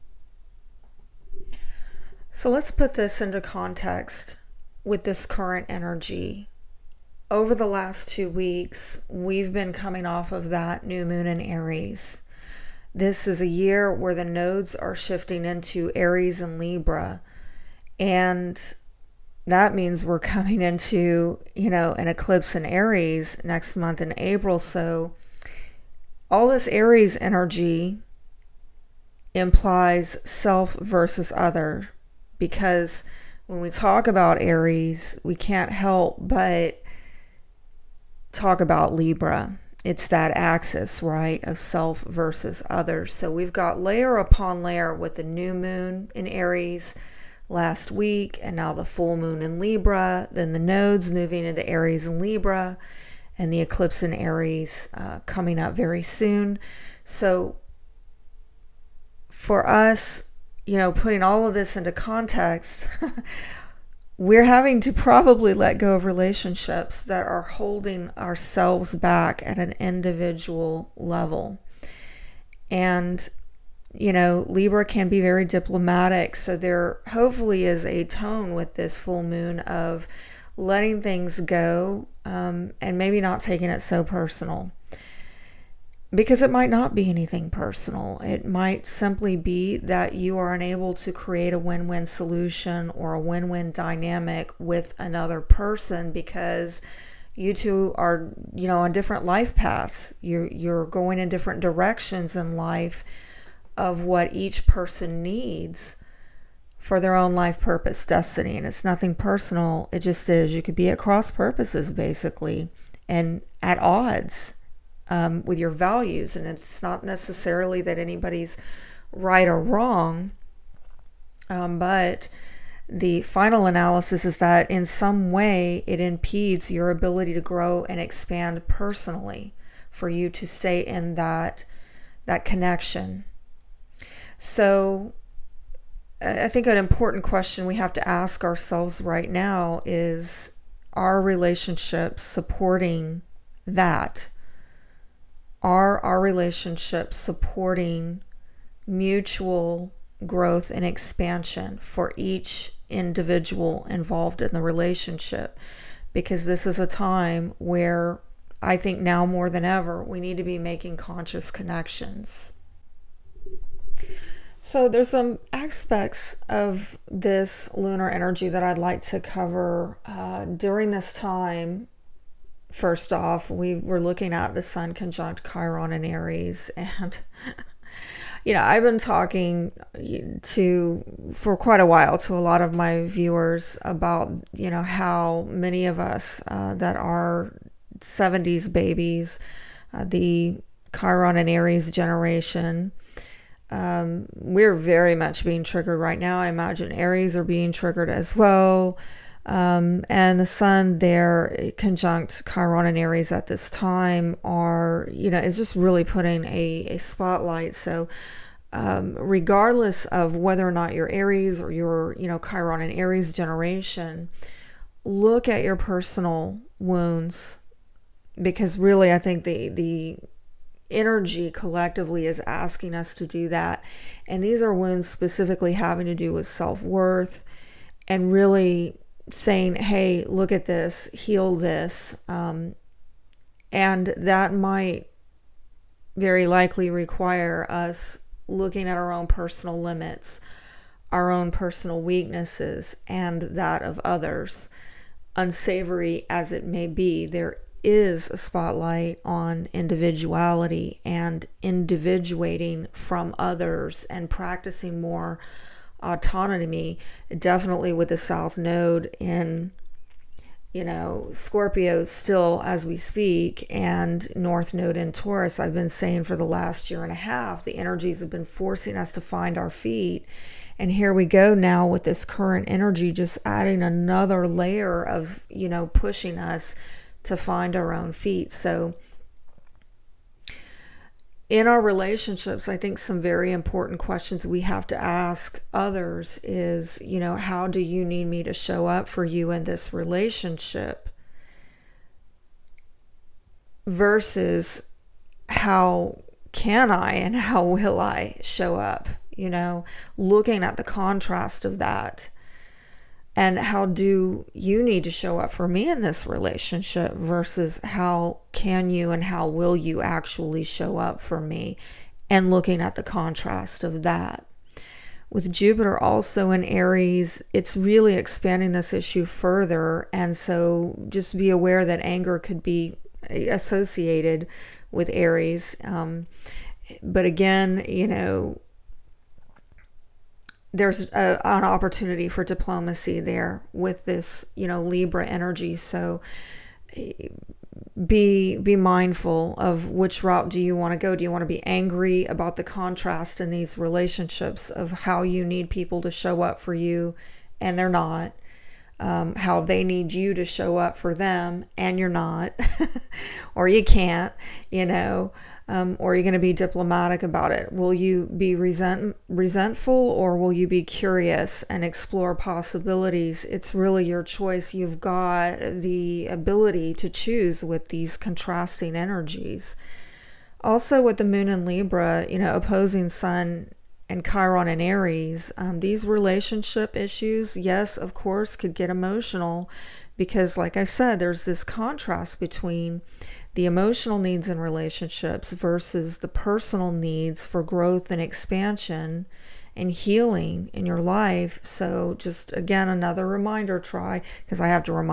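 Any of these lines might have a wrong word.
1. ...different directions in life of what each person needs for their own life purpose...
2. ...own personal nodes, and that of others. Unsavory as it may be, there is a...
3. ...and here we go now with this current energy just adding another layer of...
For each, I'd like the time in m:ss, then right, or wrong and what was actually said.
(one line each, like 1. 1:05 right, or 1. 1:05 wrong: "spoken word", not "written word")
1. 1:41 right
2. 4:01 wrong: "weaknesses", not "nodes"
3. 4:30 right.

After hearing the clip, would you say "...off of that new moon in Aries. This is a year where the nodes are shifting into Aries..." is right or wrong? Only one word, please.
right.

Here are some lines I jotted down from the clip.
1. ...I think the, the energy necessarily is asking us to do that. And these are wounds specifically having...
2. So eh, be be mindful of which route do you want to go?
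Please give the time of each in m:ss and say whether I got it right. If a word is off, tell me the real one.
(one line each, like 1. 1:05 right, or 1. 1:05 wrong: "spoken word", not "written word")
1. 3:39 wrong: "collectively", not "necessarily"
2. 5:35 right.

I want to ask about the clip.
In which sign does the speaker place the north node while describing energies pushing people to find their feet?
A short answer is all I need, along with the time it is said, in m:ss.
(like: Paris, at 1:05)
Taurus, at 4:25.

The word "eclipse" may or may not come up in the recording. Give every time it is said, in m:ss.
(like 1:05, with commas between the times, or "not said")
0:22, 0:53.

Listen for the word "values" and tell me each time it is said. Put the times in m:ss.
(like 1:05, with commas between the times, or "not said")
1:55.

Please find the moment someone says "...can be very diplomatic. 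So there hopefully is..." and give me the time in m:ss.
1:14.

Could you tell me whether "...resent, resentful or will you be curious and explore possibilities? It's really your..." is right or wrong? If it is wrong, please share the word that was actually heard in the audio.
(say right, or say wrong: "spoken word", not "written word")
right.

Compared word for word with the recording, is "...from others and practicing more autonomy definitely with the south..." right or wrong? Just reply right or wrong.
right.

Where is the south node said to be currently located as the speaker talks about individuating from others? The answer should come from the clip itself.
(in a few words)
Scorpio.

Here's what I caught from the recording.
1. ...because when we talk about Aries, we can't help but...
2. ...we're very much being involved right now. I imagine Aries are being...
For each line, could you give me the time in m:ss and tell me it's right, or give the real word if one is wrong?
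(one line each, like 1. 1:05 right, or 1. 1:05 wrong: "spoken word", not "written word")
1. 0:32 right
2. 3:14 wrong: "triggered", not "involved".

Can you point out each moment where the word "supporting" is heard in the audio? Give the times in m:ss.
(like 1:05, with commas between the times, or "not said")
2:22, 2:27.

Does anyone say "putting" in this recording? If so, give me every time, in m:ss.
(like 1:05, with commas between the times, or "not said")
1:00, 3:26.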